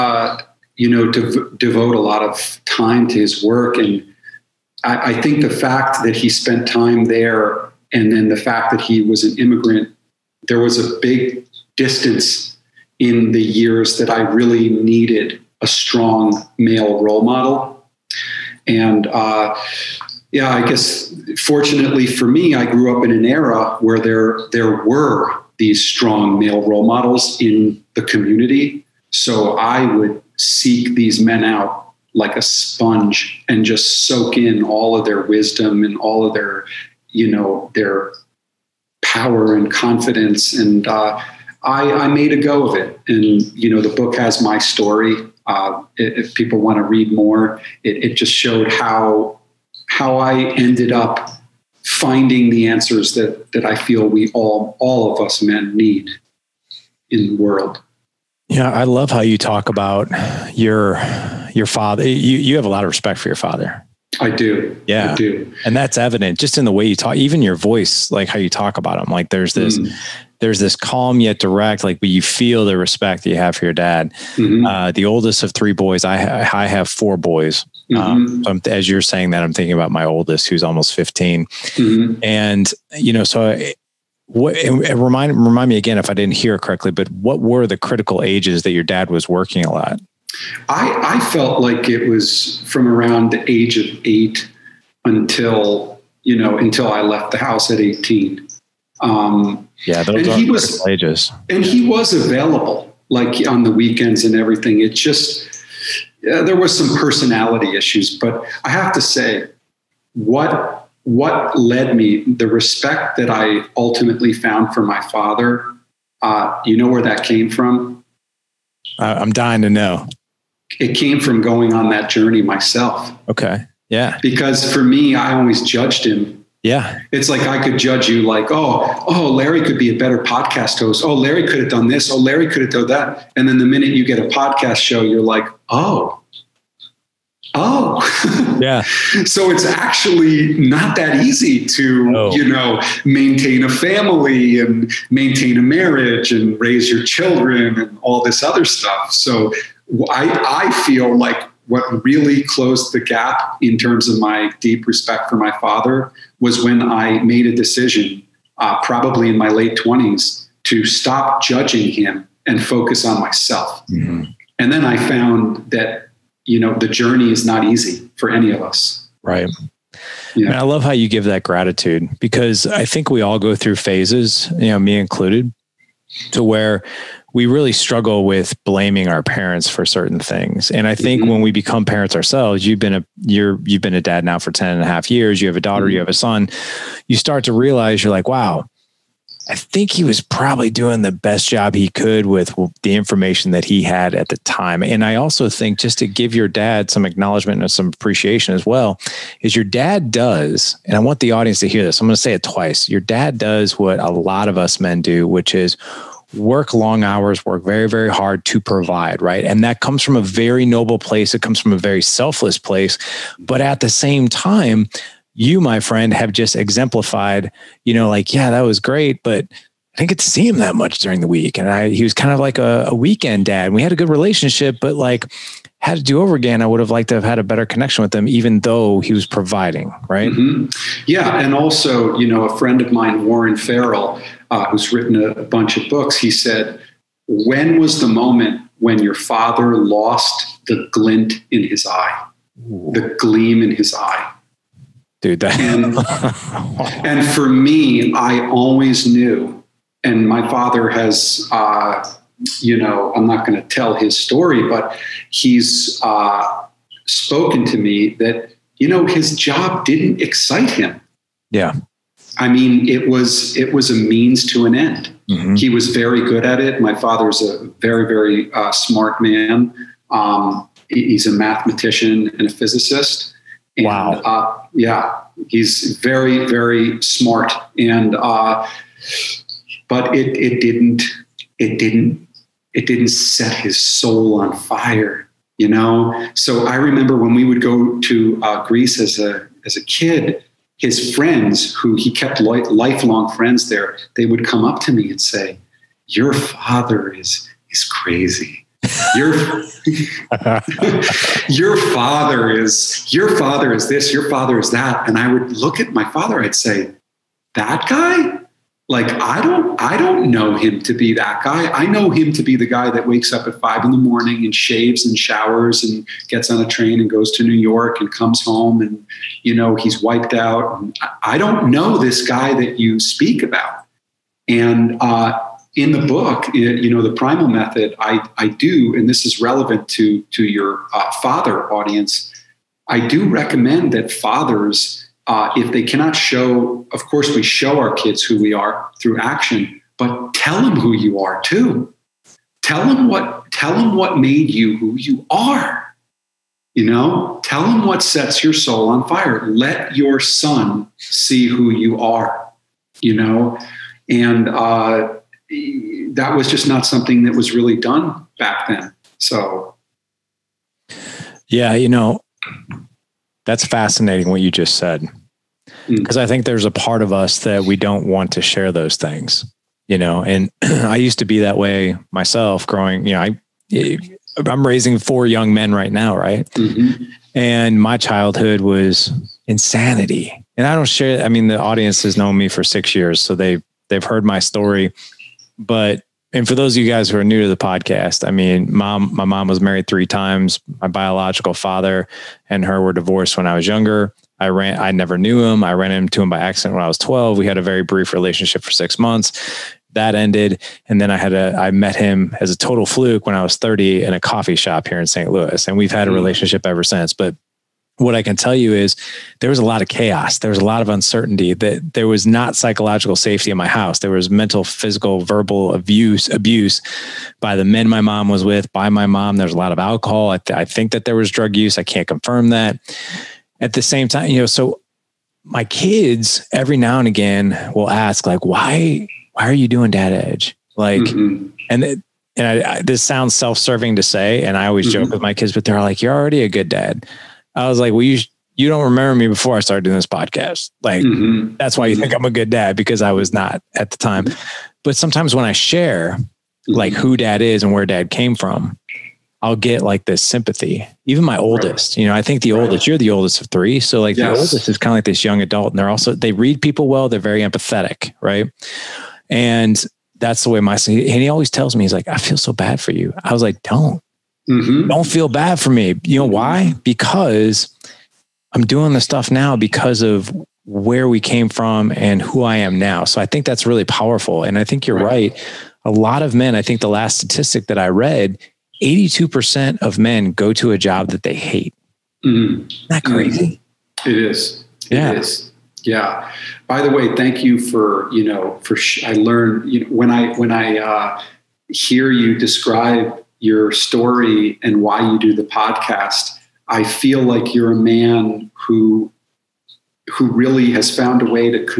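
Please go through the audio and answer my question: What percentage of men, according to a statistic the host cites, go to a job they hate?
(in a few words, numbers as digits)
82%.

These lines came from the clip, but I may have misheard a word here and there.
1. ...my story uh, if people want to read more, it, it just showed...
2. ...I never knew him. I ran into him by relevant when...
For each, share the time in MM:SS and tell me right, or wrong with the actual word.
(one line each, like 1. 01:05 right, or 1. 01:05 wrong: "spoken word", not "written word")
1. 00:44 right
2. 06:34 wrong: "accident", not "relevant".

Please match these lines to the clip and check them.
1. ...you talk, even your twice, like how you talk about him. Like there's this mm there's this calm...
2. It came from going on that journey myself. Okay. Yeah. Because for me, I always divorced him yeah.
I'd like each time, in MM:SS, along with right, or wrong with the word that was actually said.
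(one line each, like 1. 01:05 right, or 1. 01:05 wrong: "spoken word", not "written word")
1. 01:06 wrong: "voice", not "twice"
2. 02:00 wrong: "judged", not "divorced".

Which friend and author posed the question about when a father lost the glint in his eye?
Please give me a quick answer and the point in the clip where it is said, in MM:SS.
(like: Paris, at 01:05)
Warren Farrell, at 03:53.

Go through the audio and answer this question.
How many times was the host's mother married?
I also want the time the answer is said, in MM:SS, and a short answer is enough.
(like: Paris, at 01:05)
3, at 06:29.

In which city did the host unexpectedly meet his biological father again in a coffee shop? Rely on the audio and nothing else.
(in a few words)
St. Louis.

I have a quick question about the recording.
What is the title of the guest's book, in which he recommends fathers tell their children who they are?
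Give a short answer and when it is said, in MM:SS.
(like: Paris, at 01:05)
The Primal Method, at 05:27.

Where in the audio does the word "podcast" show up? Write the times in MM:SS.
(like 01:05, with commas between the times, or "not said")
02:10, 02:14, 06:27, 07:20, 08:15.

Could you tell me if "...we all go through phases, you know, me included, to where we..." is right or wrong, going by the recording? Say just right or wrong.
right.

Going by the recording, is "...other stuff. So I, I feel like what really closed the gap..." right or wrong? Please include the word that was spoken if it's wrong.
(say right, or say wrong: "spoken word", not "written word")
right.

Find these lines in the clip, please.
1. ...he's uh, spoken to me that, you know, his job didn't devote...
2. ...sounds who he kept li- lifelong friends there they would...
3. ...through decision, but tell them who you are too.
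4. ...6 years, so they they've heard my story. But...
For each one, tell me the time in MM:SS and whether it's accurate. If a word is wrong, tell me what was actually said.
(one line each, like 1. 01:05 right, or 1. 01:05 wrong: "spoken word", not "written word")
1. 04:15 wrong: "excite", not "devote"
2. 04:51 wrong: "friends", not "sounds"
3. 05:38 wrong: "action", not "decision"
4. 06:22 right.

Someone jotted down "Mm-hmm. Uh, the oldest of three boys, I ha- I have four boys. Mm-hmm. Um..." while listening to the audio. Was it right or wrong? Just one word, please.
right.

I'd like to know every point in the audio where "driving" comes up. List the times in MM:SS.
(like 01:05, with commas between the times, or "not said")
not said.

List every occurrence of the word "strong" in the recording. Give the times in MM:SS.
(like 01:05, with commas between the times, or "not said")
00:15, 00:25.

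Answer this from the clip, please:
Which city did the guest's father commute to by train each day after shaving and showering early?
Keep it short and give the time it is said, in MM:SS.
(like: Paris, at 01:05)
New York, at 05:17.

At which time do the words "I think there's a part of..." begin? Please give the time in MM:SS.
06:06.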